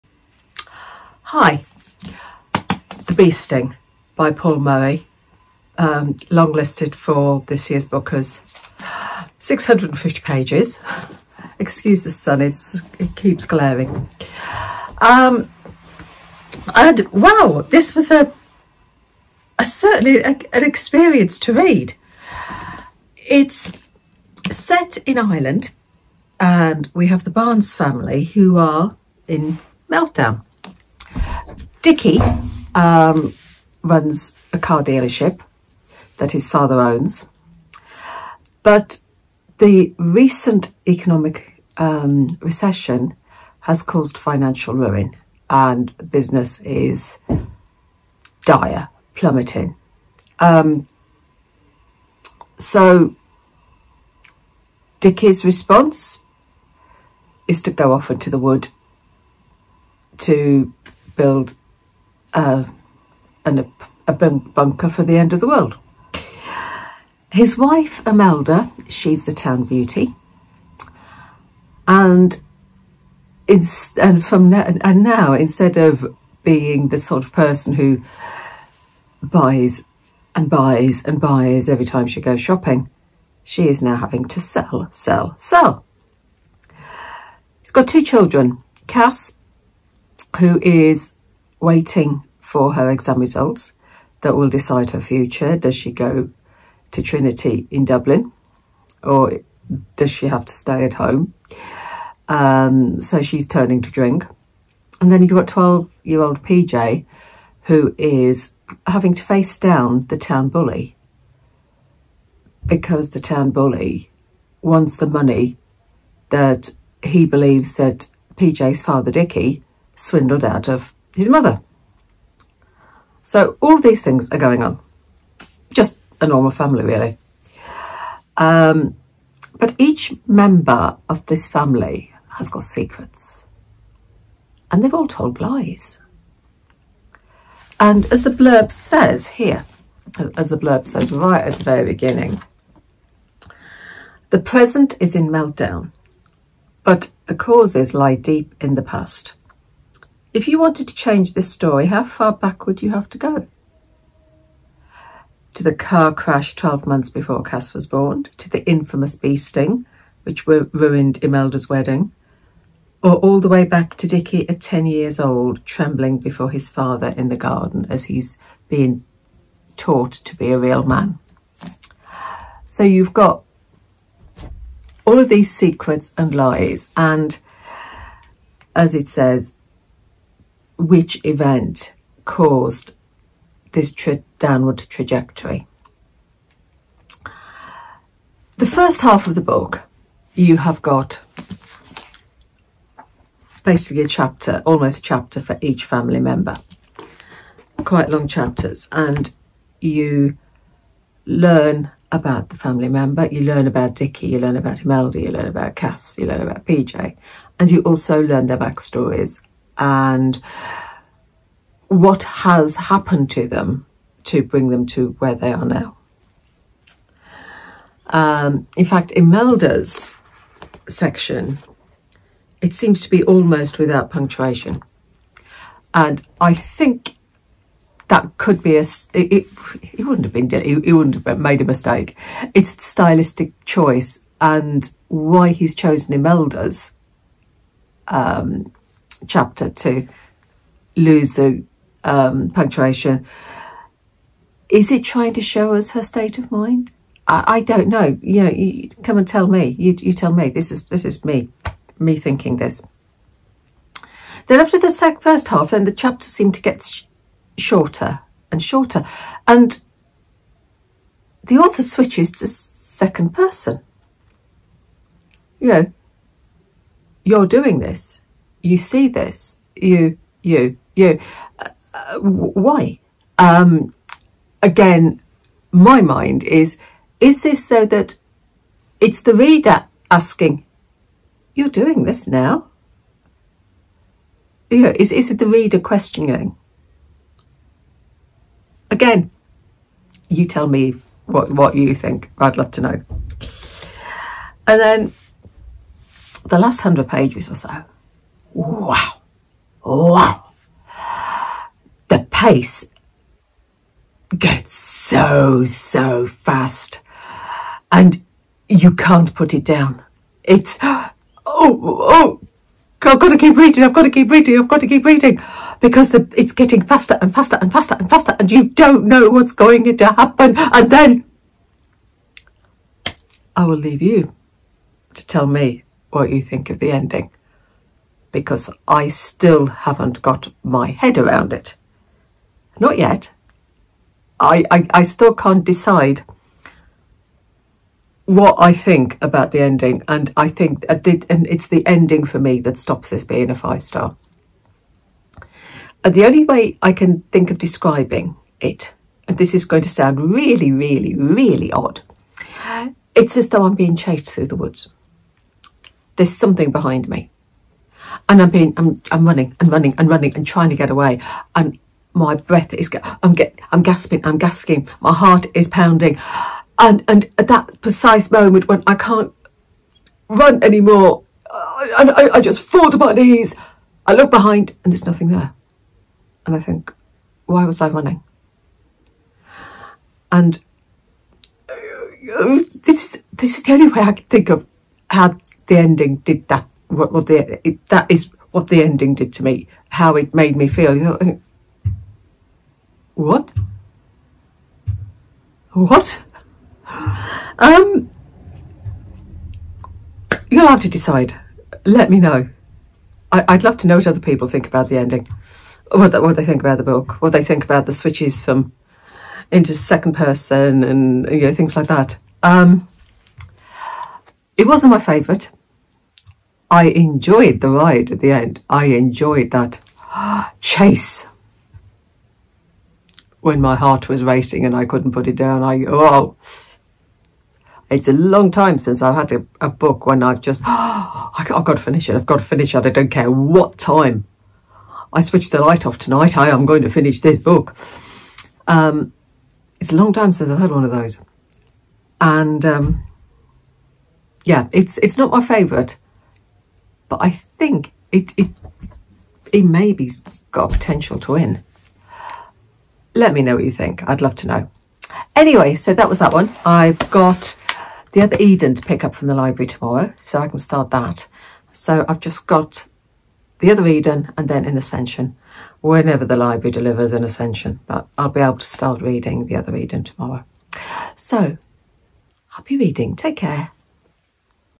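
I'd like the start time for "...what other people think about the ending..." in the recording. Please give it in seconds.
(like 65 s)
403 s.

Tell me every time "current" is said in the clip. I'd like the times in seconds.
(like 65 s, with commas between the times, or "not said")
not said.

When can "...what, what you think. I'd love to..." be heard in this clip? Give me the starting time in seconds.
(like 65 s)
291 s.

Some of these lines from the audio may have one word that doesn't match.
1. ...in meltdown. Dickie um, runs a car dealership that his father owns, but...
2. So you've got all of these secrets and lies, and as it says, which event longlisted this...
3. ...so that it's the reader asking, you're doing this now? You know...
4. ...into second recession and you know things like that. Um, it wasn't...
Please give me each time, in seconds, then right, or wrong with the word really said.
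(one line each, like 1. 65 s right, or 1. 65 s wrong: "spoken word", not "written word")
1. 29 s right
2. 172 s wrong: "caused", not "longlisted"
3. 277 s right
4. 409 s wrong: "person", not "recession".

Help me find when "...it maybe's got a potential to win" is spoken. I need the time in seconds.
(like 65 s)
449 s.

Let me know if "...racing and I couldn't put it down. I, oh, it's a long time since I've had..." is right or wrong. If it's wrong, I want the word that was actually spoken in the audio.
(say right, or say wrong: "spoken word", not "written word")
right.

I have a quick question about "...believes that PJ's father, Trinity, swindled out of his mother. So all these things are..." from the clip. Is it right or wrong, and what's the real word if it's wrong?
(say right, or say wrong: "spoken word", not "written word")
wrong: "Dickie", not "Trinity".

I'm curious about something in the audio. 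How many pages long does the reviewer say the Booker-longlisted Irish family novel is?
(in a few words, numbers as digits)
650.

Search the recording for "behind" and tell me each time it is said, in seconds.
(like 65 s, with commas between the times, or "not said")
356 s, 374 s.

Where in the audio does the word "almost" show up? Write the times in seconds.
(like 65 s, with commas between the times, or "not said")
194 s, 223 s.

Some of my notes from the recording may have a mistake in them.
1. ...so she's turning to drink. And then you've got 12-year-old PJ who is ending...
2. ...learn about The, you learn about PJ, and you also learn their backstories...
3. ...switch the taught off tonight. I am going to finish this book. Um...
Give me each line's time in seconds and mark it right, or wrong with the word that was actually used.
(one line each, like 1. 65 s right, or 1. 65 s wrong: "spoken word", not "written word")
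1. 103 s wrong: "having", not "ending"
2. 205 s wrong: "Cass", not "The"
3. 435 s wrong: "light", not "taught".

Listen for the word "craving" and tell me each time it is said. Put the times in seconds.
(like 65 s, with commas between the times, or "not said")
not said.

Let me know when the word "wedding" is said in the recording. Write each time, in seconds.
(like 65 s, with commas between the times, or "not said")
161 s.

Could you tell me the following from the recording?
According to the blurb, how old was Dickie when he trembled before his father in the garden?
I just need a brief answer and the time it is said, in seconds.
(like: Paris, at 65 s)
10, at 164 s.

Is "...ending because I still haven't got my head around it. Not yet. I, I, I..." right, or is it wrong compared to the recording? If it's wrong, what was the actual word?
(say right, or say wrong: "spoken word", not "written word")
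right.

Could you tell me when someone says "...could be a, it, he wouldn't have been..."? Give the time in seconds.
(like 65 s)
228 s.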